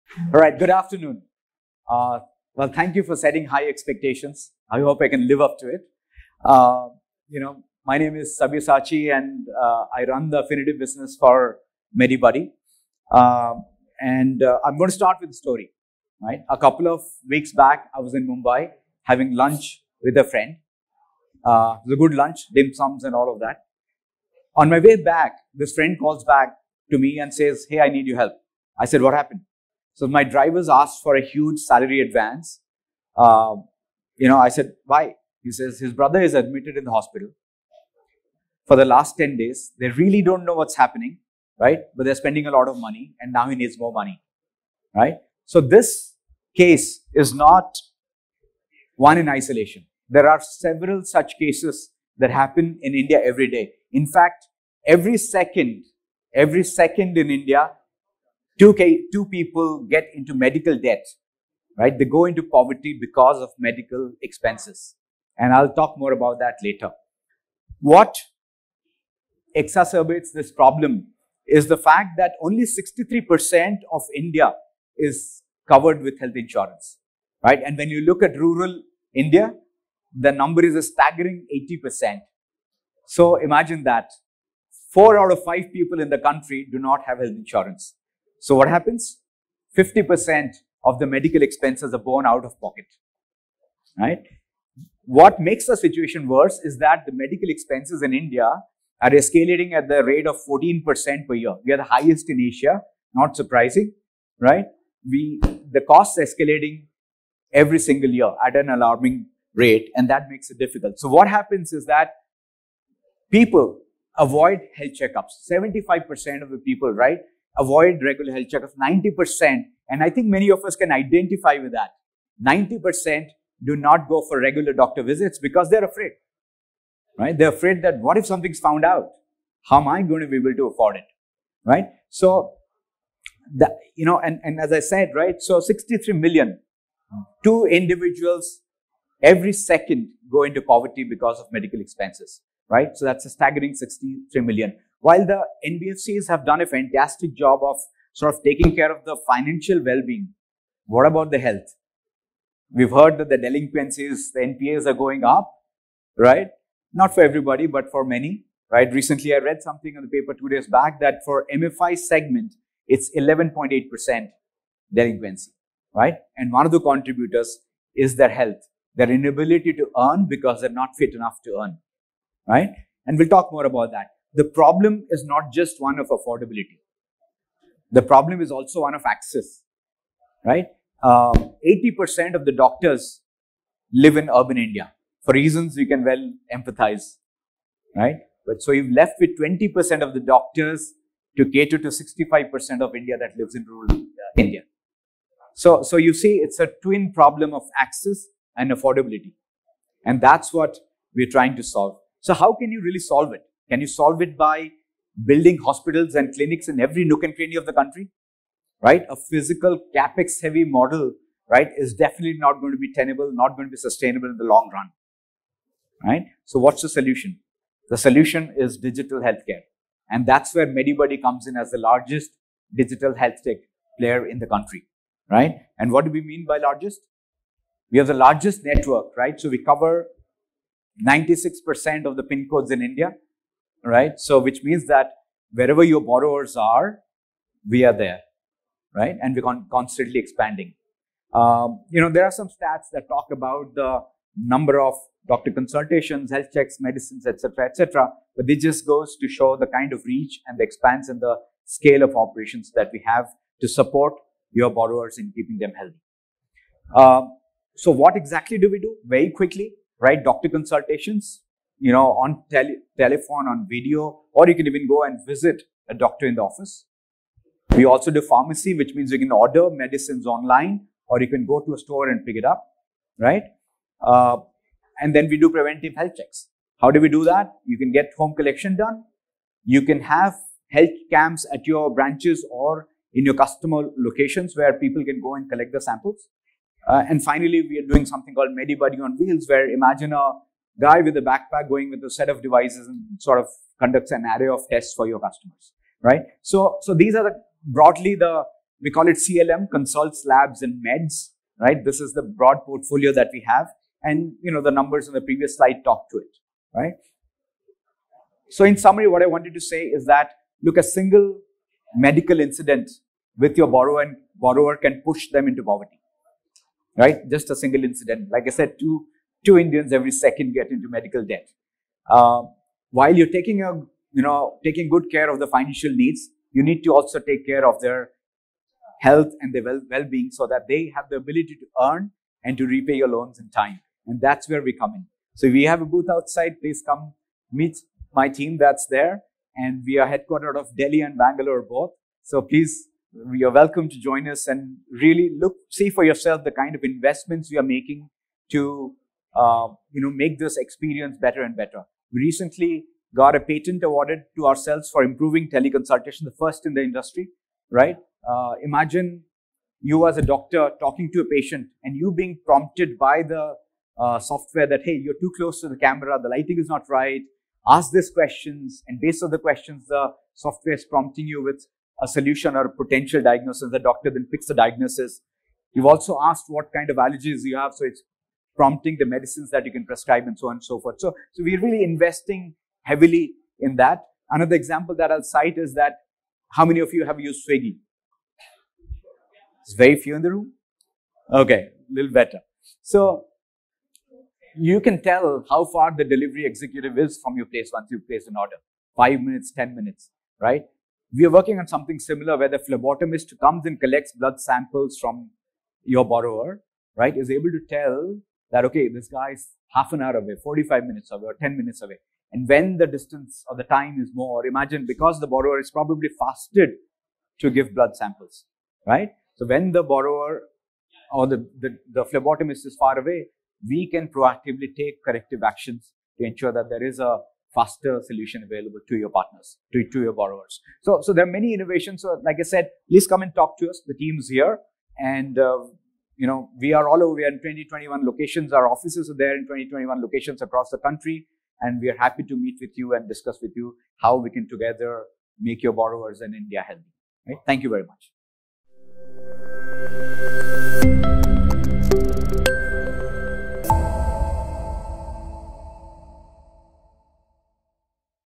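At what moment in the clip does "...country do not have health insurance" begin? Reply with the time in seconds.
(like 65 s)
86 s.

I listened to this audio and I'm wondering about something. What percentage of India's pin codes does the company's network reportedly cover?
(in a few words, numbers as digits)
96%.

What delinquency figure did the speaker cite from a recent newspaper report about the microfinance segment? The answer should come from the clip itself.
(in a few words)
11.8%.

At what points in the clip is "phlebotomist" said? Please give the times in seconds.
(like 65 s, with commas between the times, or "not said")
402 s, 422 s.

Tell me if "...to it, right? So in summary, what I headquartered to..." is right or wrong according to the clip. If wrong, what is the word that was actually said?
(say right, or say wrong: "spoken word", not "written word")
wrong: "wanted", not "headquartered".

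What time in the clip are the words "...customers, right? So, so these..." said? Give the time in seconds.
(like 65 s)
295 s.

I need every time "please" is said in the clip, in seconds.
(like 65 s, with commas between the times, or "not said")
336 s, 342 s, 432 s.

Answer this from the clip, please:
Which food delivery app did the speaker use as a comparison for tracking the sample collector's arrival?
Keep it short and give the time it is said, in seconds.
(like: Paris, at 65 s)
Swiggy, at 387 s.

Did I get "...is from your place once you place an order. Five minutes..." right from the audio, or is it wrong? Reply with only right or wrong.
right.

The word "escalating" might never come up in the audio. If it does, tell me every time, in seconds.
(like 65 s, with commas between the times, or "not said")
99 s, 106 s.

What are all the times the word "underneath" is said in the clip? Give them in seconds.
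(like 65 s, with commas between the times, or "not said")
not said.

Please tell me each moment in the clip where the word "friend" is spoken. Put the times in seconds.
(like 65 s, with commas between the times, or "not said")
20 s, 25 s.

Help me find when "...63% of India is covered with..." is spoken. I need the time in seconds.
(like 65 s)
72 s.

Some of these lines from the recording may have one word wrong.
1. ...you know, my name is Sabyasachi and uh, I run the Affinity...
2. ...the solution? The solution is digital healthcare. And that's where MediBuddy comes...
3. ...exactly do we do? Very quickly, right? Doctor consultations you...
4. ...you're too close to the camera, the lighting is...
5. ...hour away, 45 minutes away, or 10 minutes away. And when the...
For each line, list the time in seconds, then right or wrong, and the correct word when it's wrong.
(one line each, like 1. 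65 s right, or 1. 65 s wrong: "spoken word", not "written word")
1. 7 s right
2. 216 s right
3. 258 s right
4. 365 s right
5. 410 s right.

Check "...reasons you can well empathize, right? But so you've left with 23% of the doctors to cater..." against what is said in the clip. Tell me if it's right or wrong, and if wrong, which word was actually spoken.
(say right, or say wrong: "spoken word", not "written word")
wrong: "20", not "23".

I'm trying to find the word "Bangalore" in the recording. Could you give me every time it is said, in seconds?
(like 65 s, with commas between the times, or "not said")
341 s.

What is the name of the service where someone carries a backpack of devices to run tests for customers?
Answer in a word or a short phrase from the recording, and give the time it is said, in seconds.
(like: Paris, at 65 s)
MediBuddy on Wheels, at 288 s.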